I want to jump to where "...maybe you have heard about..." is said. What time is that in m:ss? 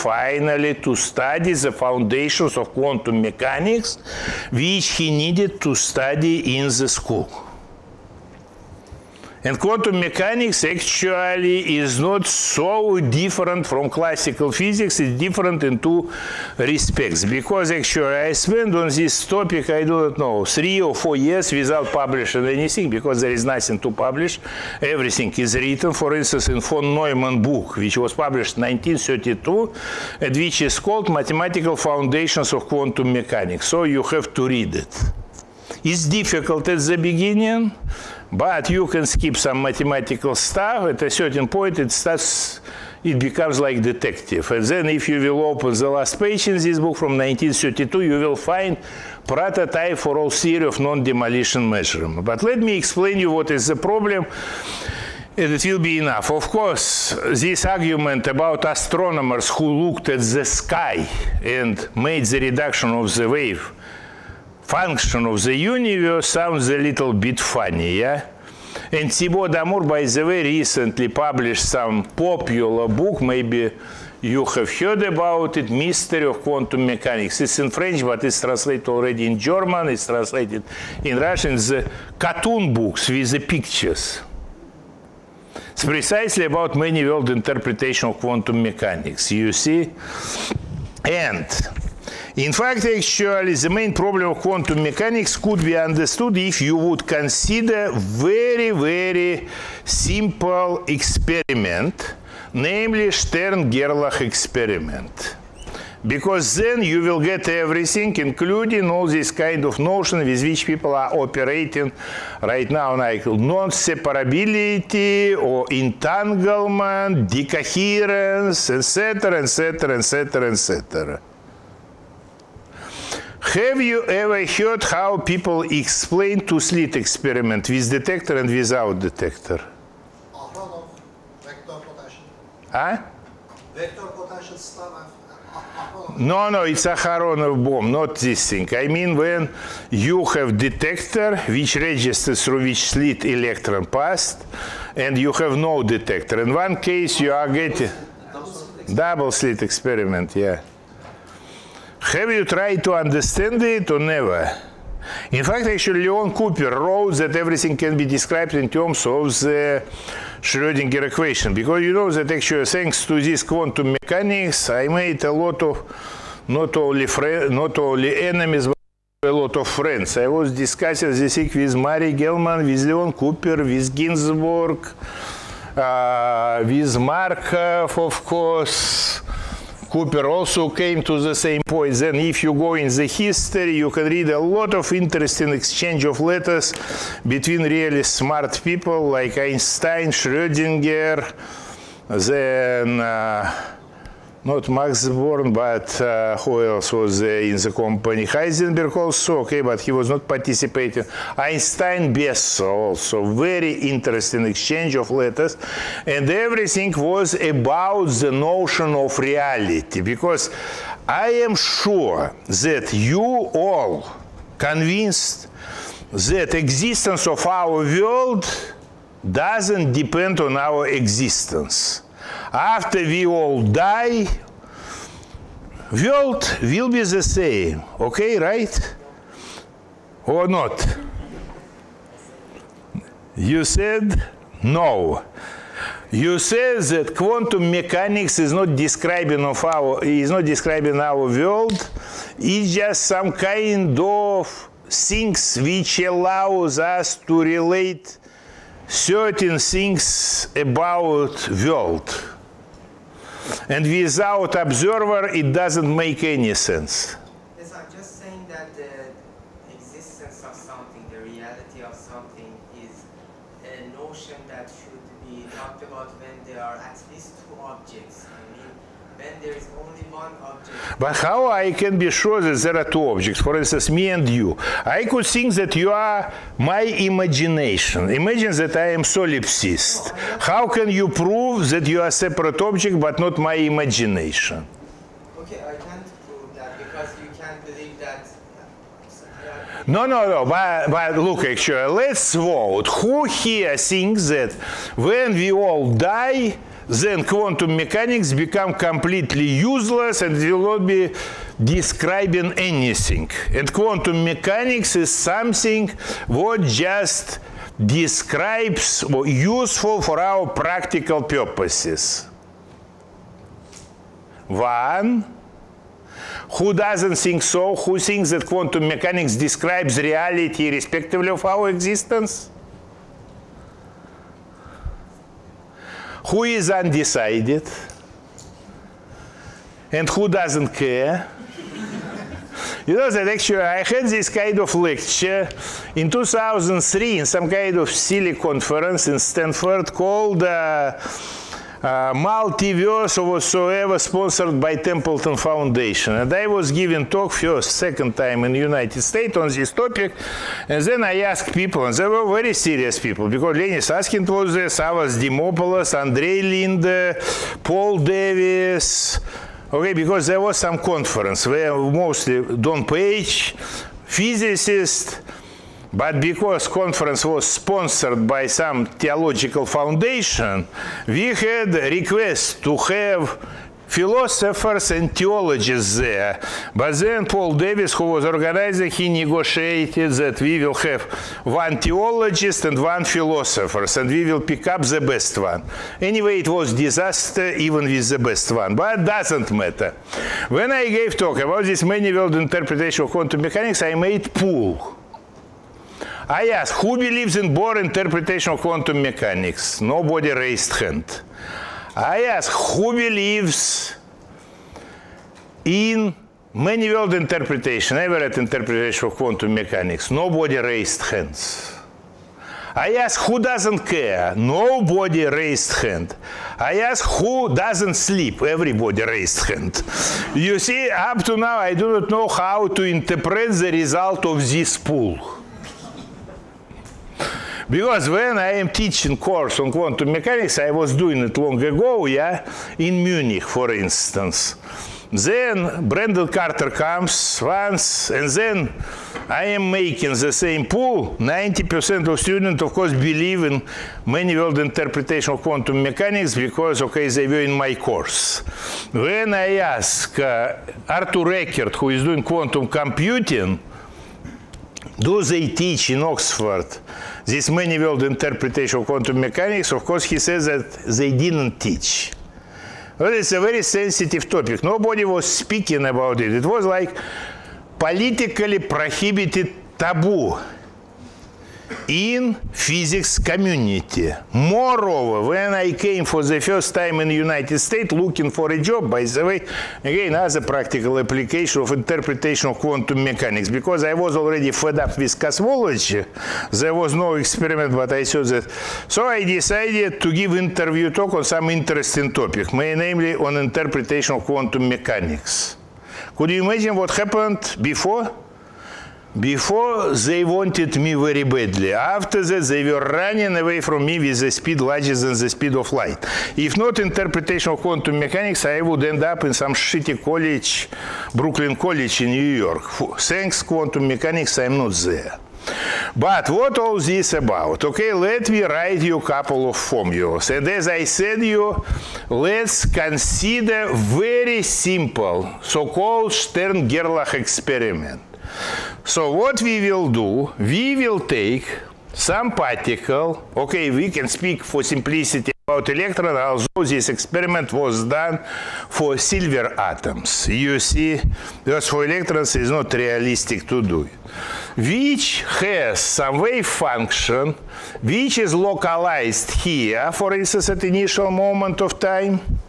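1:13.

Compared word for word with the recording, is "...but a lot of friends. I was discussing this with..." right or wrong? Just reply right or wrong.
right.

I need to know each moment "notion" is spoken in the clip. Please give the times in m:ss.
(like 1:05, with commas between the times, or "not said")
1:49, 3:28.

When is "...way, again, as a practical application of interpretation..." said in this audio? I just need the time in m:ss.
7:59.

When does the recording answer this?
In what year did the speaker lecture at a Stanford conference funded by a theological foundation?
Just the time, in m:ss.
5:36.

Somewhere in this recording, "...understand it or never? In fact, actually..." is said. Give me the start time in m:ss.
2:32.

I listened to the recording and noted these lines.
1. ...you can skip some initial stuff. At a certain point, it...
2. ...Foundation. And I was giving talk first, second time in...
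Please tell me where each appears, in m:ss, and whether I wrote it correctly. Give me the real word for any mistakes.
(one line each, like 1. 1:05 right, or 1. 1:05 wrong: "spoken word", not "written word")
1. 0:38 wrong: "mathematical", not "initial"
2. 5:45 right.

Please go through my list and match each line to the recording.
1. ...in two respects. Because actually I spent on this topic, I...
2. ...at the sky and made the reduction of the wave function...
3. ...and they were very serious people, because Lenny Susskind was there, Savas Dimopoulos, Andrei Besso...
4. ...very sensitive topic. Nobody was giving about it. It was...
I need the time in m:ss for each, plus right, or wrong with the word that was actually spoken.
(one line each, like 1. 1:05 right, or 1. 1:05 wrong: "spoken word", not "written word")
1. 0:15 right
2. 1:00 right
3. 5:51 wrong: "Linde", not "Besso"
4. 7:43 wrong: "speaking", not "giving".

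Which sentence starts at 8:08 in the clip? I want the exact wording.
So I decided to give interview talk on some interesting topic, namely on interpretation of quantum mechanics.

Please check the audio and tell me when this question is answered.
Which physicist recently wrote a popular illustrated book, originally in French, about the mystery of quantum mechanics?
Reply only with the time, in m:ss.
1:09.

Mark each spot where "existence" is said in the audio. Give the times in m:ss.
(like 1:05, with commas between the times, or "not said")
3:36, 3:40, 5:21.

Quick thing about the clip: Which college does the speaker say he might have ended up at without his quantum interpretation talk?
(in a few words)
Brooklyn College.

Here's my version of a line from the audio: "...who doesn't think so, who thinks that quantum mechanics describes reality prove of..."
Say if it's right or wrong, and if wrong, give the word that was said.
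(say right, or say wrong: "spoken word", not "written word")
wrong: "irrespective", not "prove".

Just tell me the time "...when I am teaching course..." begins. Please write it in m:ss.
7:08.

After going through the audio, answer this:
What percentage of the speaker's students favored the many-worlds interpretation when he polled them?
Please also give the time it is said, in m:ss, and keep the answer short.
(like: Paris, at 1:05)
90%, at 7:21.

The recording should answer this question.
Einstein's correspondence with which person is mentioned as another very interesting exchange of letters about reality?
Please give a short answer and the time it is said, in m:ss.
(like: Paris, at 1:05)
Besso, at 3:22.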